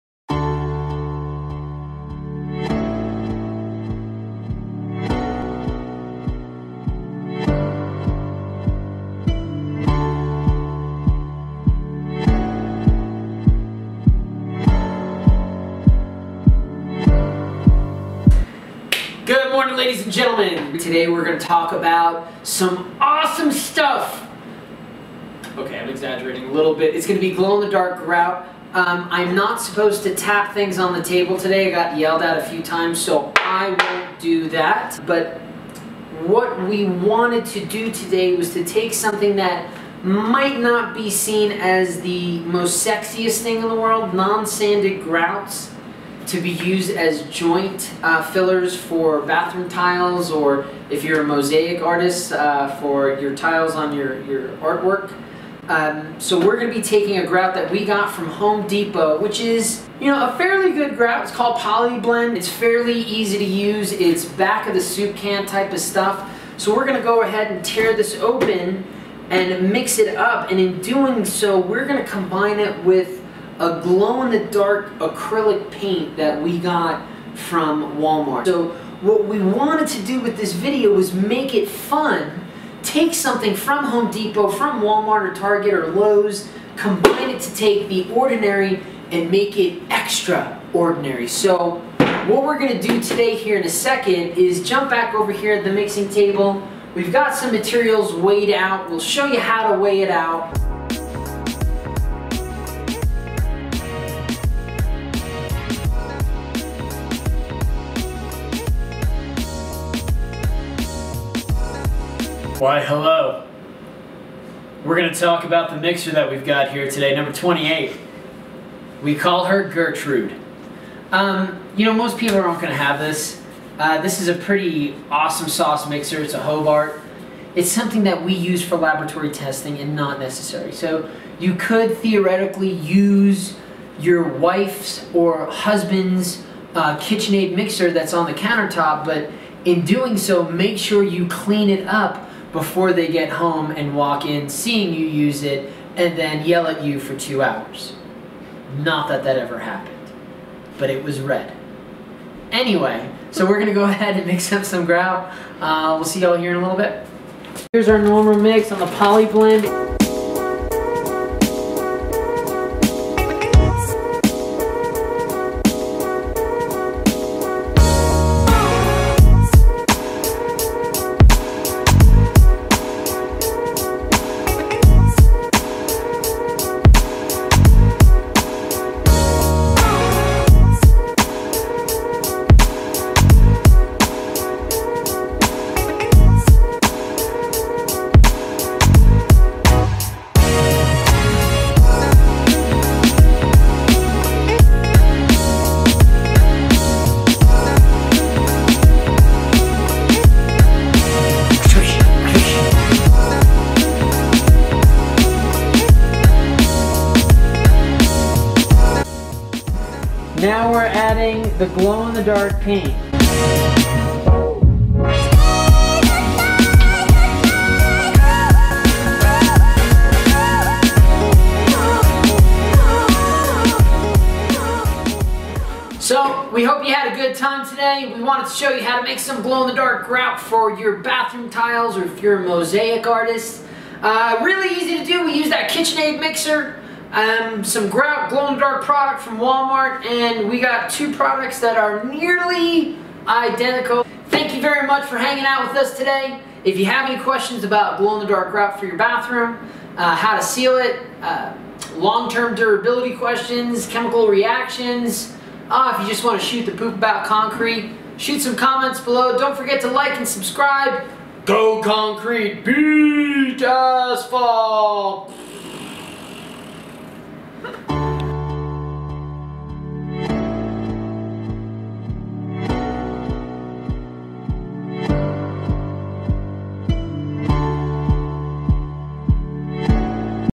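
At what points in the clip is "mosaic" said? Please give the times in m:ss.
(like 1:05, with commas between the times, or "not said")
0:51, 3:52.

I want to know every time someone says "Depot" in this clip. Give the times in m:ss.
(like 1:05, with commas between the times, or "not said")
0:58, 1:24.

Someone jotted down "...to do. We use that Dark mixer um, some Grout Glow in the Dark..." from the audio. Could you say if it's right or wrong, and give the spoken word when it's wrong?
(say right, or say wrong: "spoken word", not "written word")
wrong: "KitchenAid", not "Dark".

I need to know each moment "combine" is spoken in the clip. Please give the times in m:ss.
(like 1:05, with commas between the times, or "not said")
1:12, 1:26.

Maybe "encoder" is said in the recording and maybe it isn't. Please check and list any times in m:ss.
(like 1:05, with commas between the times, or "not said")
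not said.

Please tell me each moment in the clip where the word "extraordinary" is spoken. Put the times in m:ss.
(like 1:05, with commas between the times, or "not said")
1:29.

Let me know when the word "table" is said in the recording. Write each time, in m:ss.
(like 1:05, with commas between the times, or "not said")
0:31, 1:36.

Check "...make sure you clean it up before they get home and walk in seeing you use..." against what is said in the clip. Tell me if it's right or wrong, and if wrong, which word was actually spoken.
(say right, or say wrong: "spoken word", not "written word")
right.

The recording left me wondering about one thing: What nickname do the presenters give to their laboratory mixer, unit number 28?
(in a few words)
Gertrude.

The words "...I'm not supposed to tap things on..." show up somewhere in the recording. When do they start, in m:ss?
0:29.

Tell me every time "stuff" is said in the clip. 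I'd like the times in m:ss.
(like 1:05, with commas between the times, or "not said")
0:23, 1:05.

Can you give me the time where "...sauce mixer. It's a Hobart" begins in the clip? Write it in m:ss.
2:05.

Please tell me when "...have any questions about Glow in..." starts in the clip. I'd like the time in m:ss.
4:06.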